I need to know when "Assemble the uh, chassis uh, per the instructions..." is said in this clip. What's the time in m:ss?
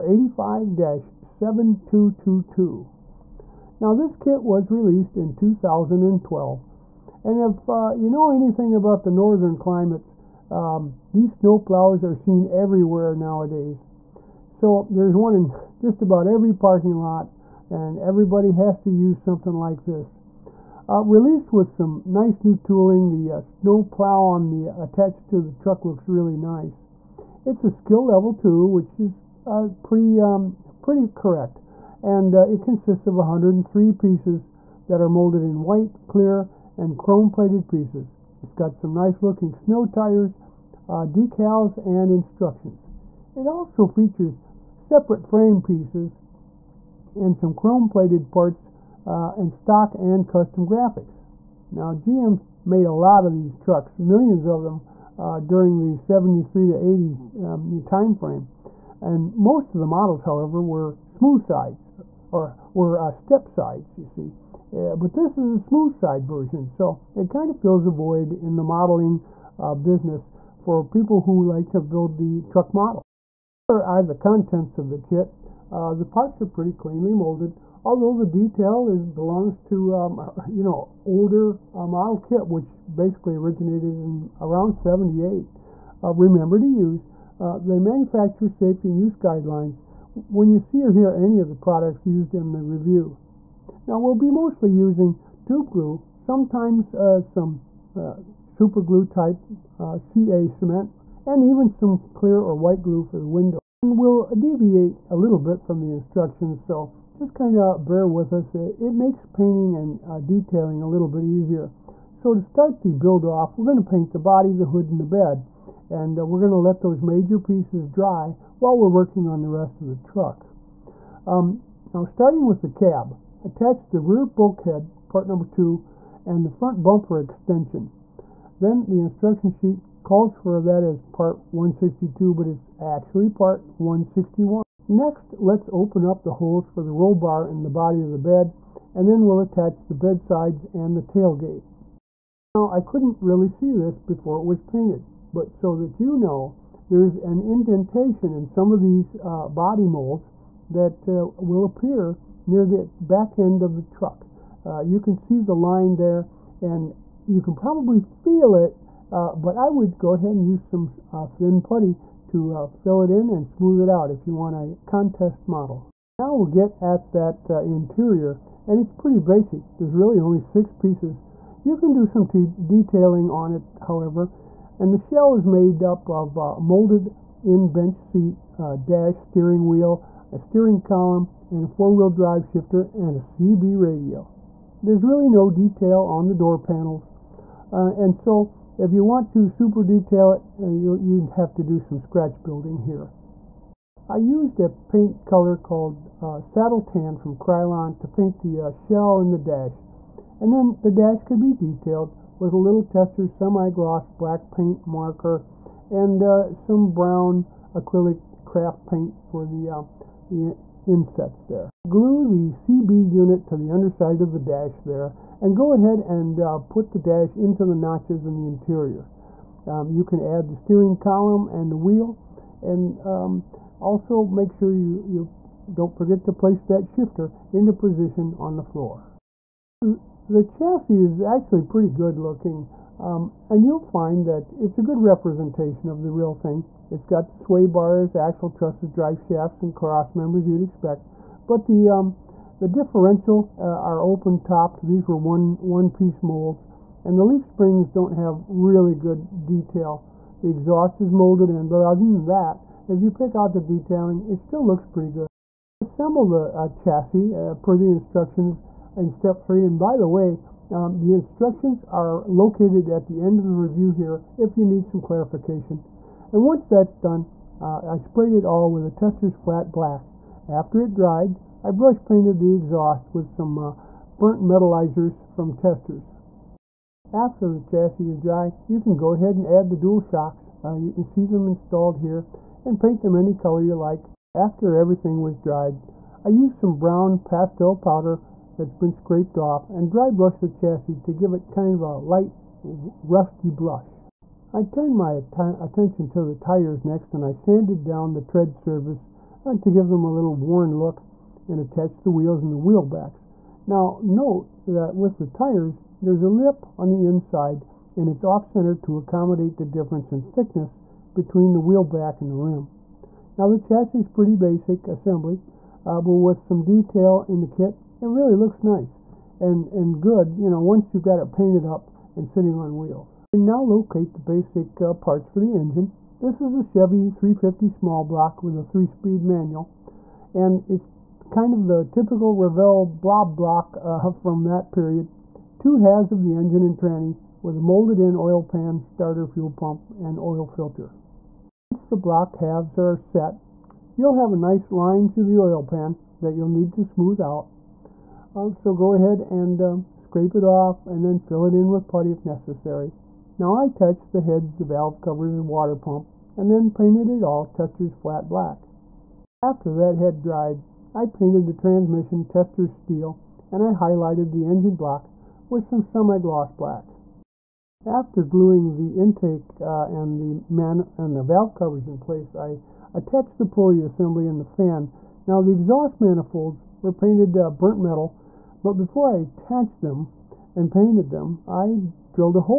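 4:15.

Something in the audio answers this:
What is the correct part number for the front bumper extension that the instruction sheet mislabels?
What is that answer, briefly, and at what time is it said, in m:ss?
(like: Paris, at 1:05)
161, at 2:13.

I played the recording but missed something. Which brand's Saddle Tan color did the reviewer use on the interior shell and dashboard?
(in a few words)
Krylon.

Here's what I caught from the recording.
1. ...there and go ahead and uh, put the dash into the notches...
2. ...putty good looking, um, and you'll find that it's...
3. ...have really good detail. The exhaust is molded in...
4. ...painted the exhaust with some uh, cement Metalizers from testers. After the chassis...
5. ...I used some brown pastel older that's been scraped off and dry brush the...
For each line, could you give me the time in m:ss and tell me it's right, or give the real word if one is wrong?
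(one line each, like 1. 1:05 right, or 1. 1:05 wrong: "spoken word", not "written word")
1. 3:34 right
2. 3:51 wrong: "pretty", not "putty"
3. 4:08 right
4. 4:32 wrong: "burnt", not "cement"
5. 4:46 wrong: "powder", not "older".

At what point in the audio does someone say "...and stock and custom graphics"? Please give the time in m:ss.
0:49.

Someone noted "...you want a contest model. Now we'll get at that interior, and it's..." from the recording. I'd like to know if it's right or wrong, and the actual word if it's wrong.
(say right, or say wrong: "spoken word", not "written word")
right.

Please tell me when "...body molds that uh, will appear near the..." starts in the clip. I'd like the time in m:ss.
2:29.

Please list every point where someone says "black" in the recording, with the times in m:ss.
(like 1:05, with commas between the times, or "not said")
3:24, 4:29, 5:58, 6:06.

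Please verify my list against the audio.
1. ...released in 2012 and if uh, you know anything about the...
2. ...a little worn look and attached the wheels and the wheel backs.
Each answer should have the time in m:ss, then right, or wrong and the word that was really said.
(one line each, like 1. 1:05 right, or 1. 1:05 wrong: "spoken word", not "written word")
1. 0:04 right
2. 5:00 right.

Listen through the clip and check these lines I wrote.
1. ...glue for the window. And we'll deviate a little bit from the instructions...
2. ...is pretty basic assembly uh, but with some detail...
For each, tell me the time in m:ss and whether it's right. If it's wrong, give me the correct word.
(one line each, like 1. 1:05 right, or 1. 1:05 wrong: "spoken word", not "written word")
1. 1:42 right
2. 5:13 right.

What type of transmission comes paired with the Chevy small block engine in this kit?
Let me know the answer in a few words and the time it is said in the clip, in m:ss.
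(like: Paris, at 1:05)
three-speed manual, at 5:28.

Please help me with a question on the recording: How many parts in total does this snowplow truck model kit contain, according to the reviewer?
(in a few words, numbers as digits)
103.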